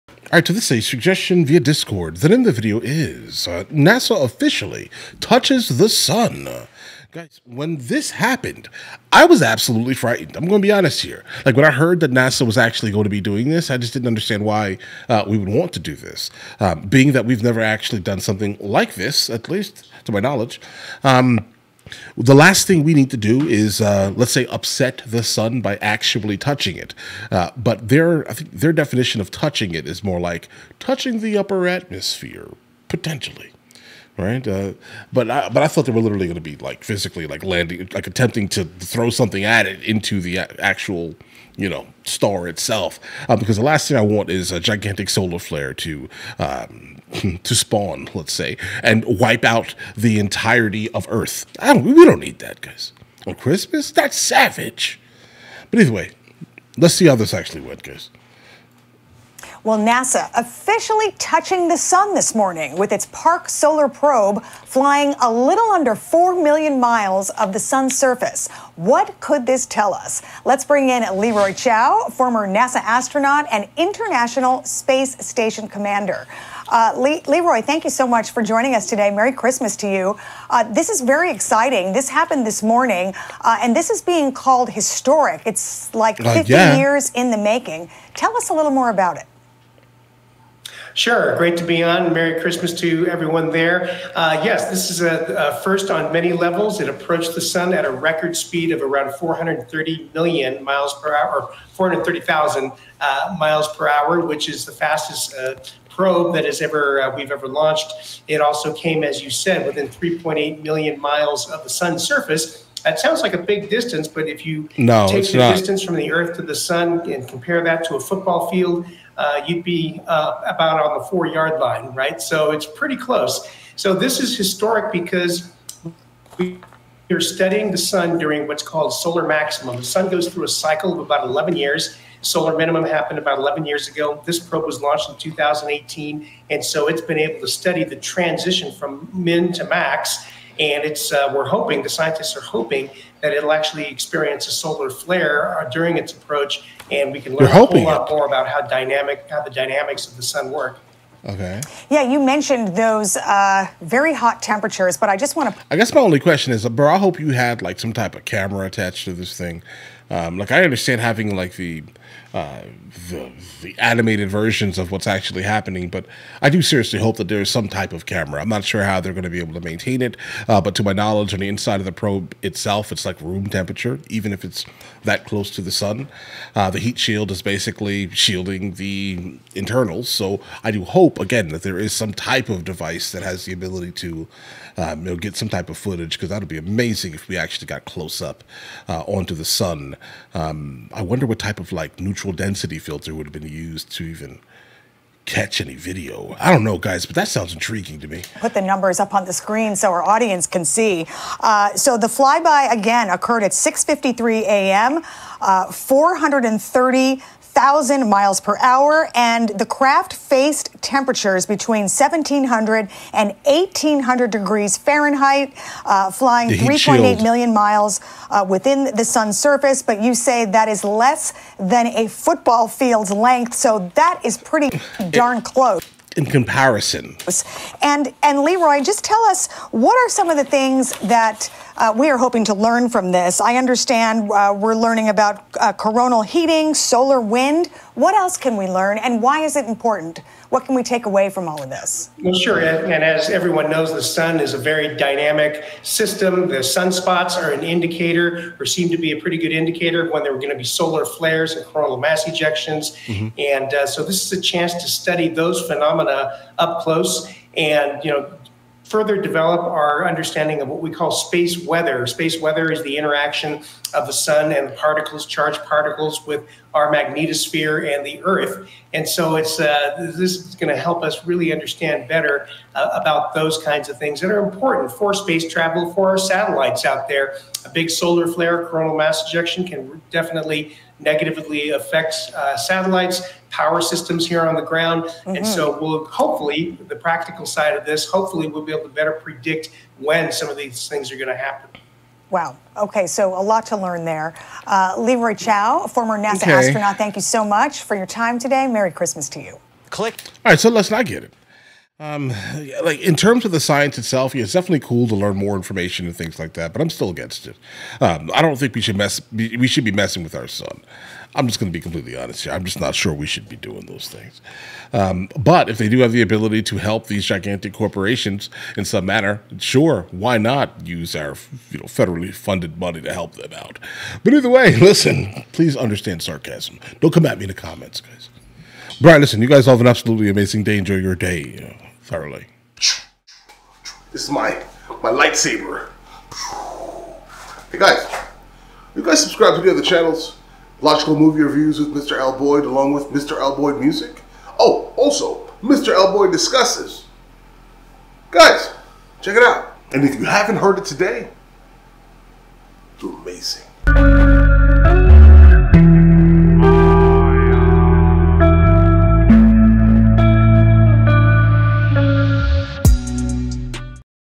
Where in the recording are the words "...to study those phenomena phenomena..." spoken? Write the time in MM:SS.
04:14.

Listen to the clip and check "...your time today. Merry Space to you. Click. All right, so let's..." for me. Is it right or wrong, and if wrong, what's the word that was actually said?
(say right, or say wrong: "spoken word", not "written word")
wrong: "Christmas", not "Space".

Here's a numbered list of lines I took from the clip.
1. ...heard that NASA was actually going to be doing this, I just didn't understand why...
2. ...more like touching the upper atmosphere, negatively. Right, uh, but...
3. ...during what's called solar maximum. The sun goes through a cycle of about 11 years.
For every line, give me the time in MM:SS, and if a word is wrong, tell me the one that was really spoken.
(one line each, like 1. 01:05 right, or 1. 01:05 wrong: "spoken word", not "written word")
1. 00:11 right
2. 00:30 wrong: "potentially", not "negatively"
3. 02:08 right.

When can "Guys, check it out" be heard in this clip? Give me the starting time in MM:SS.
05:48.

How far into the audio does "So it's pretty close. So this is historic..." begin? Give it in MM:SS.
02:02.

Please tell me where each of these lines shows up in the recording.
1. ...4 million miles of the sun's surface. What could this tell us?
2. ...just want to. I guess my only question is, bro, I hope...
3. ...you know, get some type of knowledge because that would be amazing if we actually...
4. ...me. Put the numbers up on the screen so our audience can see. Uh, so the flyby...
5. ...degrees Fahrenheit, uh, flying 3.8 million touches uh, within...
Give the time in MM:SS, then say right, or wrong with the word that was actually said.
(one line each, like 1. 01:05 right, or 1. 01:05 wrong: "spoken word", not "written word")
1. 01:05 right
2. 02:35 right
3. 03:05 wrong: "footage", not "knowledge"
4. 03:18 right
5. 03:34 wrong: "miles", not "touches".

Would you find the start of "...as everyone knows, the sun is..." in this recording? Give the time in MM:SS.
04:03.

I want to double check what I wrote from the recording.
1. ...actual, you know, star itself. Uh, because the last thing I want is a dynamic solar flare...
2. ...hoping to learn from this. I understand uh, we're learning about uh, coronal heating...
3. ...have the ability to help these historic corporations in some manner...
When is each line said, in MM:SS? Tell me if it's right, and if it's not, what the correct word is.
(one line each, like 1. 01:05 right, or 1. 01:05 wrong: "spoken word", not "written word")
1. 00:40 wrong: "gigantic", not "dynamic"
2. 03:52 right
3. 05:15 wrong: "gigantic", not "historic".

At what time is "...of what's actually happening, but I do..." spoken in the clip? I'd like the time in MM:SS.
02:44.